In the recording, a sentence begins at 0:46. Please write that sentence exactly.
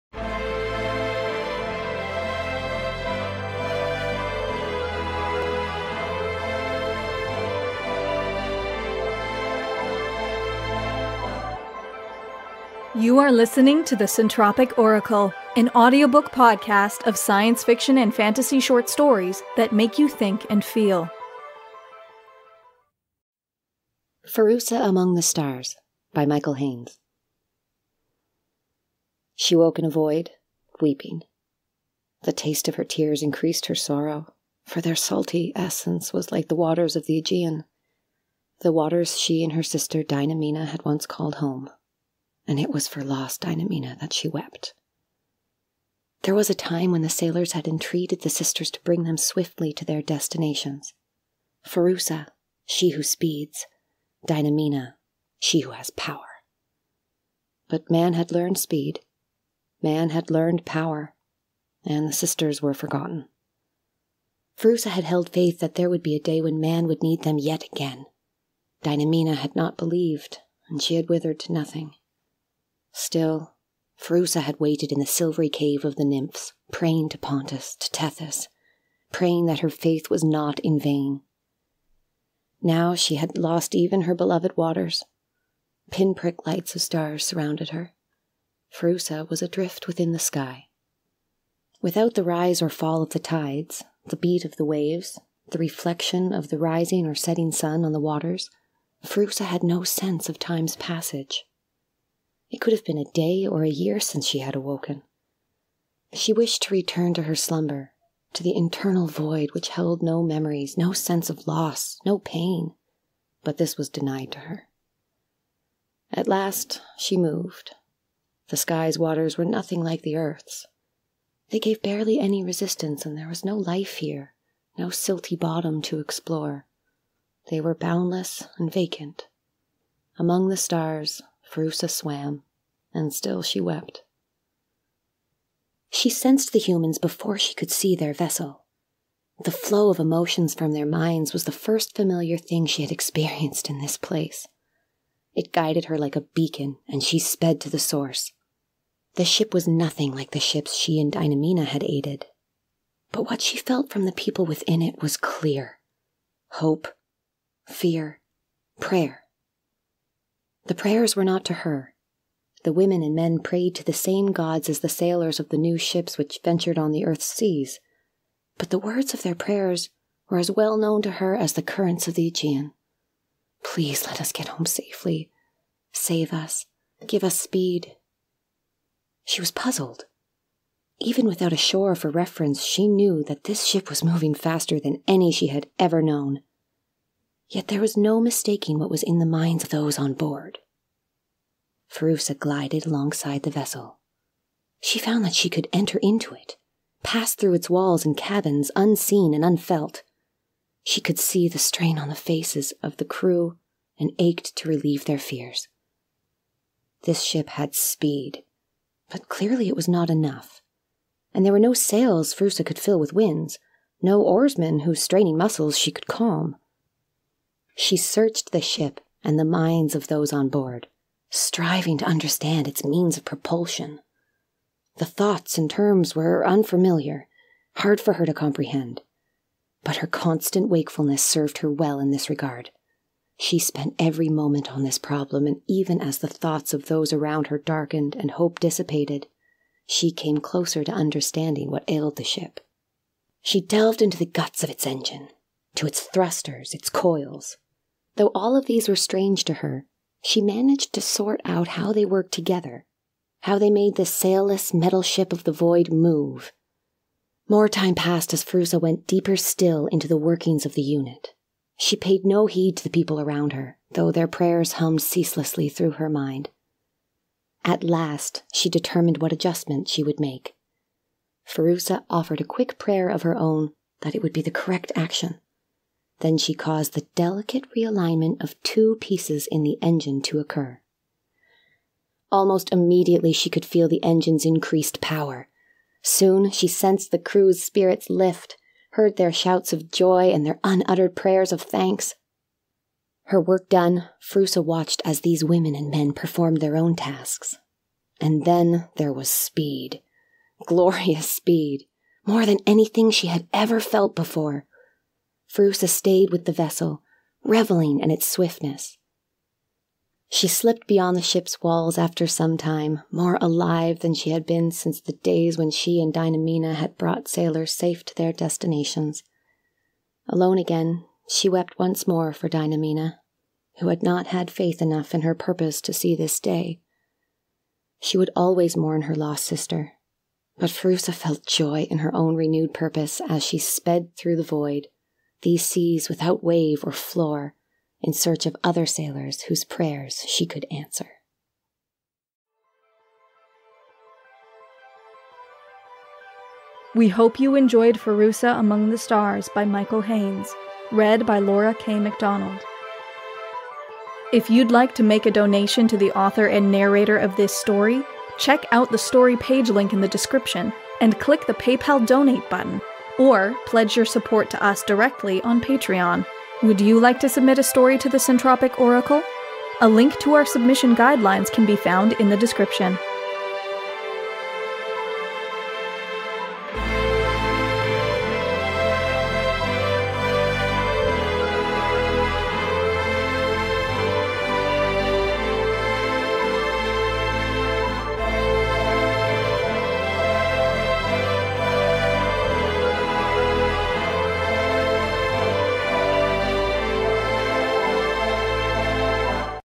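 There was a time when the sailors had entreated the sisters to bring them swiftly to their destinations.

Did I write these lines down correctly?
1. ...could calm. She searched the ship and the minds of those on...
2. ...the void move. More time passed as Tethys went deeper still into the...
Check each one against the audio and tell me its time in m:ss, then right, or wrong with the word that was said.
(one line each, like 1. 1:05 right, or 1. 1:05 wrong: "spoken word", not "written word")
1. 3:35 right
2. 4:15 wrong: "Pherusa", not "Tethys".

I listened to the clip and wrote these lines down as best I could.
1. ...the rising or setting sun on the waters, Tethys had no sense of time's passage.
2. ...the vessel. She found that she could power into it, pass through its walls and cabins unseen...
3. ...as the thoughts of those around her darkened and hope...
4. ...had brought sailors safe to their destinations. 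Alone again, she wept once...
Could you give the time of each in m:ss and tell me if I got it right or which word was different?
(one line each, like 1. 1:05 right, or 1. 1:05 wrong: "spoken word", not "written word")
1. 1:36 wrong: "Pherusa", not "Tethys"
2. 3:13 wrong: "enter", not "power"
3. 3:55 right
4. 5:16 right.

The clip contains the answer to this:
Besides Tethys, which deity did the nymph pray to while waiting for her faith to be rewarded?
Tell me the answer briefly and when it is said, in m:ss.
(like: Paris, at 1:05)
Pontus, at 1:17.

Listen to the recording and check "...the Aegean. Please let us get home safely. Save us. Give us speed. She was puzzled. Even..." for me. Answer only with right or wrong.
right.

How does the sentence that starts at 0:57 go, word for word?
But man had learned speed, man had learned power, and the sisters were forgotten.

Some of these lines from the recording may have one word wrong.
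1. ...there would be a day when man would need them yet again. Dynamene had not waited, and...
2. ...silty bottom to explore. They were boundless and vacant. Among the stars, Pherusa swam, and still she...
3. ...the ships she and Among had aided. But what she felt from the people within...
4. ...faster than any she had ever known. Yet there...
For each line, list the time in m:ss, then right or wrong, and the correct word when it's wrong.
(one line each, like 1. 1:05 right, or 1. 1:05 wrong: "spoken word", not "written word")
1. 1:05 wrong: "believed", not "waited"
2. 2:04 right
3. 2:30 wrong: "Dynamene", not "Among"
4. 3:04 right.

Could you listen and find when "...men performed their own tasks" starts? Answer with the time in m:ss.
4:55.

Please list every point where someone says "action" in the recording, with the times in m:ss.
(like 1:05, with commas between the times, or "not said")
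4:34.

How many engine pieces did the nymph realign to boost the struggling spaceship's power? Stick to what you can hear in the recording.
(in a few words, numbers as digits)
2.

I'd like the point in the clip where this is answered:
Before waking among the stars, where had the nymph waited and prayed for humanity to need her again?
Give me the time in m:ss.
1:15.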